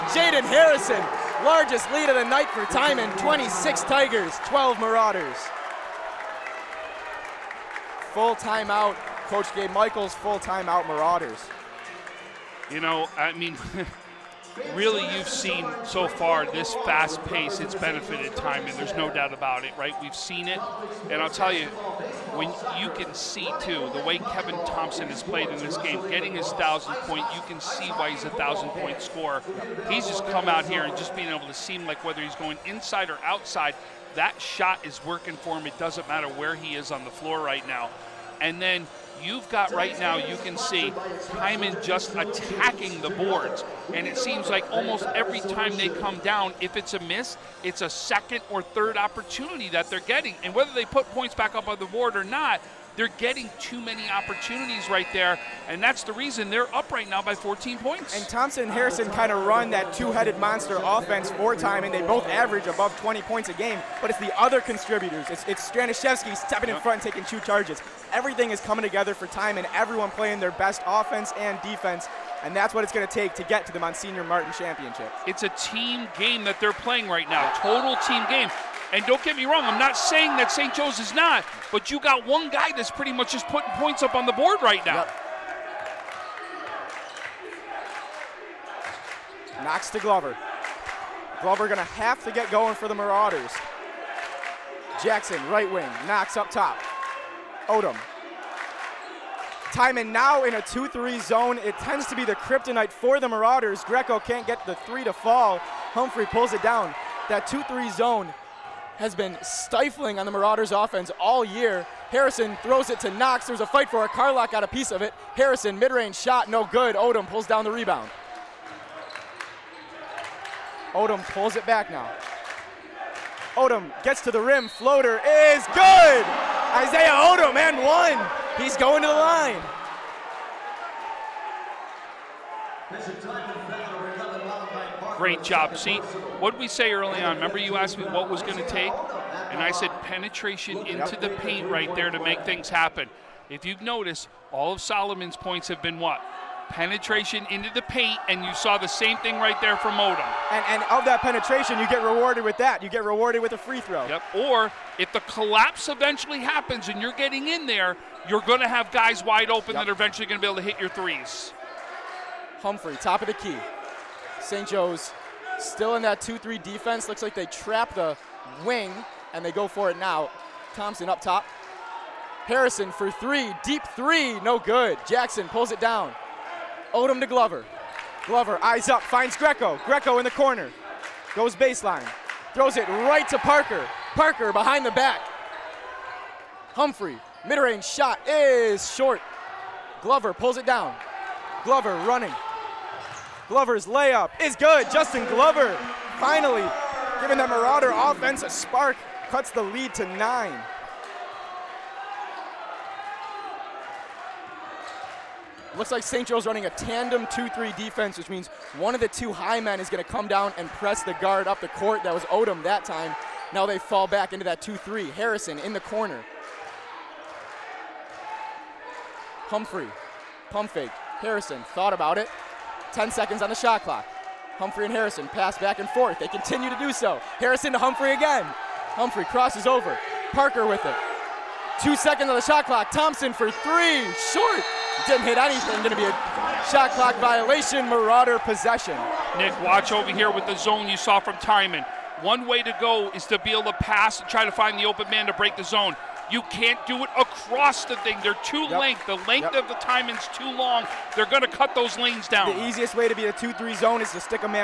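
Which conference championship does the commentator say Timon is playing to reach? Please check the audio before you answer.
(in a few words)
Monsignor Martin Championship.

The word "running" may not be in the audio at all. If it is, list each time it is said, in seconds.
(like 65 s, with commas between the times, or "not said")
192 s, 206 s.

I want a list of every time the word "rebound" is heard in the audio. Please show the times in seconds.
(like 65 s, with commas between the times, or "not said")
117 s.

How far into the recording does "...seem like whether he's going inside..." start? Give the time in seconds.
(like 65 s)
31 s.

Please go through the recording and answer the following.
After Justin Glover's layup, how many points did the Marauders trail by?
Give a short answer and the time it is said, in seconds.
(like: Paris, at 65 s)
9, at 200 s.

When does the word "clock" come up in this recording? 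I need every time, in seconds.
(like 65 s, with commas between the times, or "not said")
223 s, 232 s, 236 s.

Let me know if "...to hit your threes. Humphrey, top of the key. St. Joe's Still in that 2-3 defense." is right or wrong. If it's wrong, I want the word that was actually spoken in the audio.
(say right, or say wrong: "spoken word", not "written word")
right.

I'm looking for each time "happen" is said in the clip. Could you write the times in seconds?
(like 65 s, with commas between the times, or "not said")
142 s, 156 s.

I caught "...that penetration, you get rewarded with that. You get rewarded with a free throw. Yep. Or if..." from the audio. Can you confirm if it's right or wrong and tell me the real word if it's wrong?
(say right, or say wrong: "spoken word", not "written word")
right.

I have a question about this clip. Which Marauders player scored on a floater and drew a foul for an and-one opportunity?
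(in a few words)
Isaiah Odom.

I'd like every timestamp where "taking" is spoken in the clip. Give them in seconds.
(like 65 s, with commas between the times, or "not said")
67 s.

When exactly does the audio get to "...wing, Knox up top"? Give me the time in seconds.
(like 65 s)
95 s.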